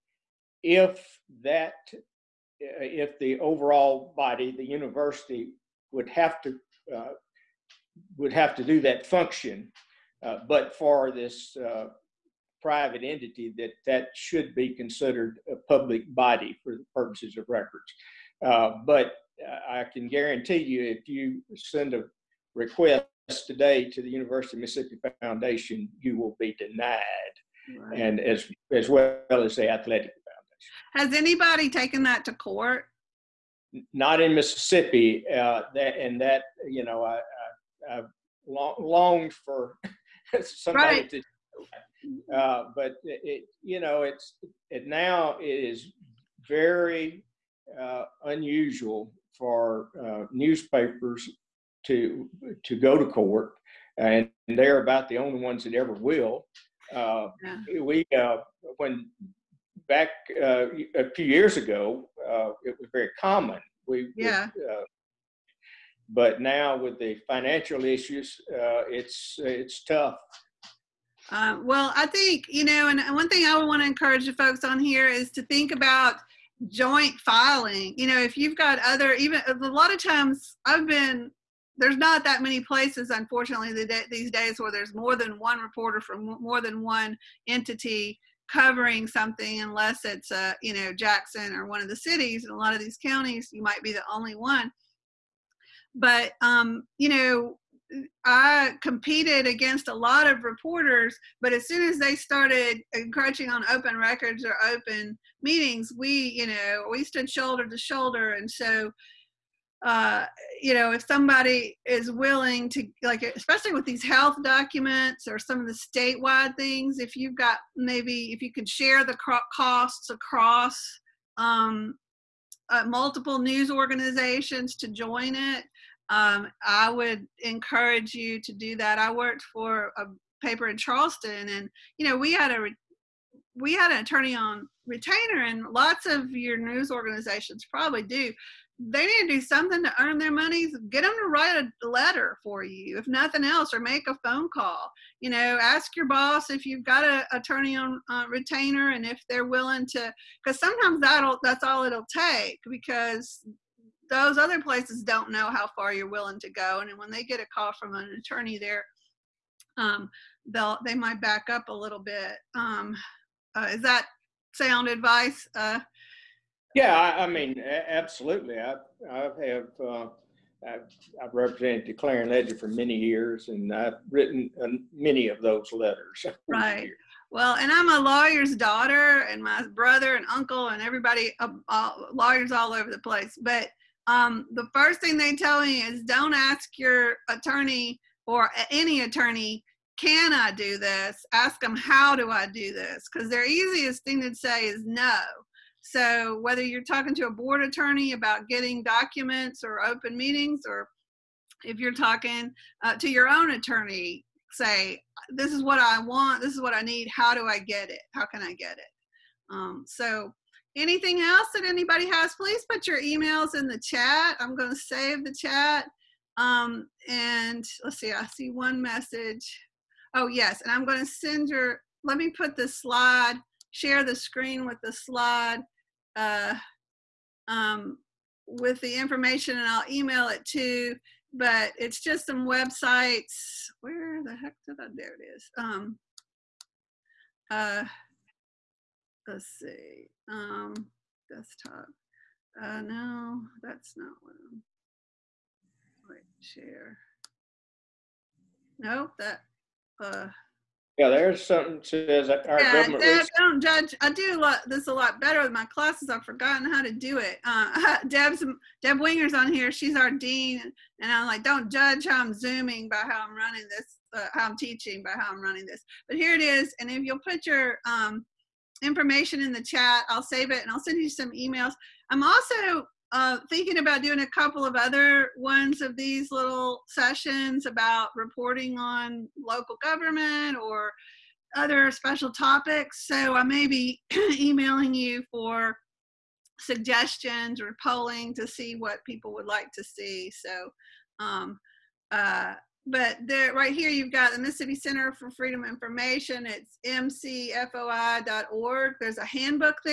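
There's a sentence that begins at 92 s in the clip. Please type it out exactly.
In a lot of these counties, you might be the only one.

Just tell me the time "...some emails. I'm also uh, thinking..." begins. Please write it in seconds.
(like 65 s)
271 s.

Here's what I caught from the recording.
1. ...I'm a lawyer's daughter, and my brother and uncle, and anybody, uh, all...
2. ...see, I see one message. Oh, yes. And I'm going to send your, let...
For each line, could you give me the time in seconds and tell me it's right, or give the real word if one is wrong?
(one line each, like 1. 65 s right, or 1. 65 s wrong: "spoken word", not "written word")
1. 177 s wrong: "everybody", not "anybody"
2. 217 s right.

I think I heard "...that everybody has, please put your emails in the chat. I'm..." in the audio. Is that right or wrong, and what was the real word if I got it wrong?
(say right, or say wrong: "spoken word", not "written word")
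wrong: "anybody", not "everybody".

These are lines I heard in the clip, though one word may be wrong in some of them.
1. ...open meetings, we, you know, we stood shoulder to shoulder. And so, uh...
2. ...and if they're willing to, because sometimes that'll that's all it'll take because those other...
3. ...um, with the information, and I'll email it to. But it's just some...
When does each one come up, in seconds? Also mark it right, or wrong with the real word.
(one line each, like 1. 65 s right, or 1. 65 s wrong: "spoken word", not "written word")
1. 104 s right
2. 148 s right
3. 227 s right.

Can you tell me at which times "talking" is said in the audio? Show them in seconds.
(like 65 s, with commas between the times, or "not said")
196 s, 201 s.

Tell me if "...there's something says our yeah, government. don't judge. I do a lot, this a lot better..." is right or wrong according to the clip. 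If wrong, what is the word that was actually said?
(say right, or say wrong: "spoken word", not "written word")
right.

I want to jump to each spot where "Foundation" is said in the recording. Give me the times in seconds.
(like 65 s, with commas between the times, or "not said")
25 s, 30 s.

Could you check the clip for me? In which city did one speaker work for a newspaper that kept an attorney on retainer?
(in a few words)
Charleston.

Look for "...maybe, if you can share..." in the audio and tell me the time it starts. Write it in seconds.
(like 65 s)
117 s.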